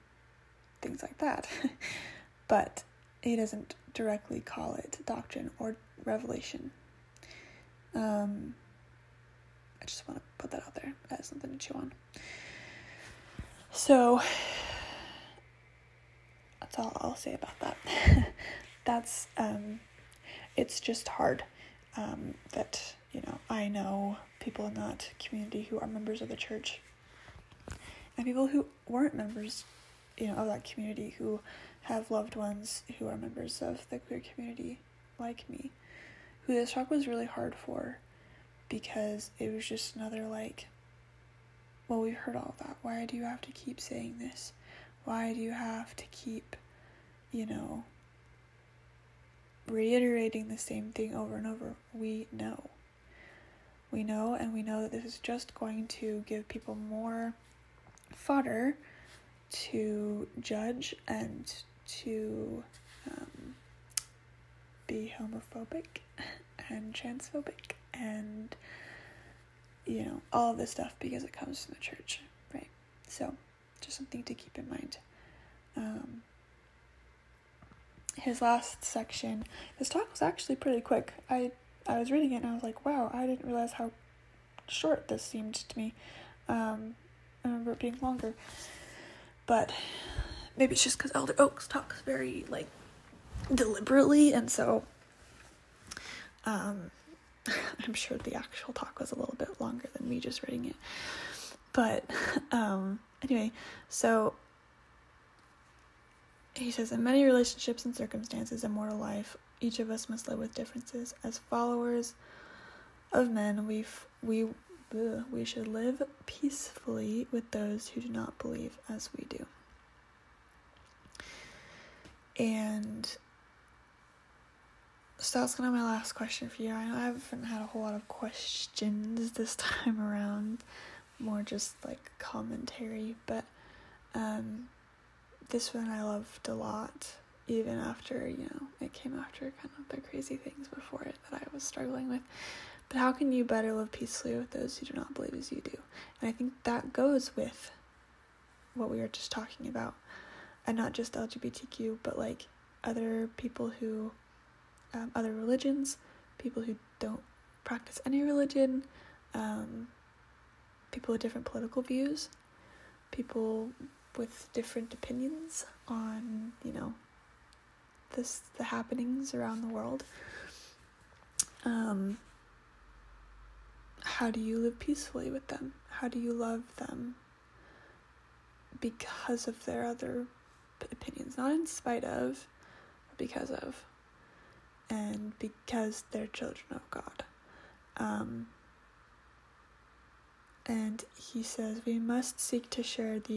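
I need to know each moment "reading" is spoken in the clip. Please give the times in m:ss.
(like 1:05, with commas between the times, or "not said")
1:22, 1:40.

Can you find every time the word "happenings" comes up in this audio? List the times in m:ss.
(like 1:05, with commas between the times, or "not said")
2:48.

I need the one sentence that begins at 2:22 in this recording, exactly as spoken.
But how can you better live peacefully with those who do not believe as you do?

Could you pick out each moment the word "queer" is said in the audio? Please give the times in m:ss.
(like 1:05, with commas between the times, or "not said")
0:33.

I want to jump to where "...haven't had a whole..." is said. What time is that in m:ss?
2:07.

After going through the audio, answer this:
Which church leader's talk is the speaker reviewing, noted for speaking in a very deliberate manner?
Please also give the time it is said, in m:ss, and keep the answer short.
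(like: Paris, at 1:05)
Elder Oaks, at 1:31.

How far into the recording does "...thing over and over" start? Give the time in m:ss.
0:50.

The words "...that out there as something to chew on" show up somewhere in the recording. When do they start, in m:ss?
0:10.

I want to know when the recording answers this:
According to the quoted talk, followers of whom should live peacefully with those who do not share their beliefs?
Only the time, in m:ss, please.
1:51.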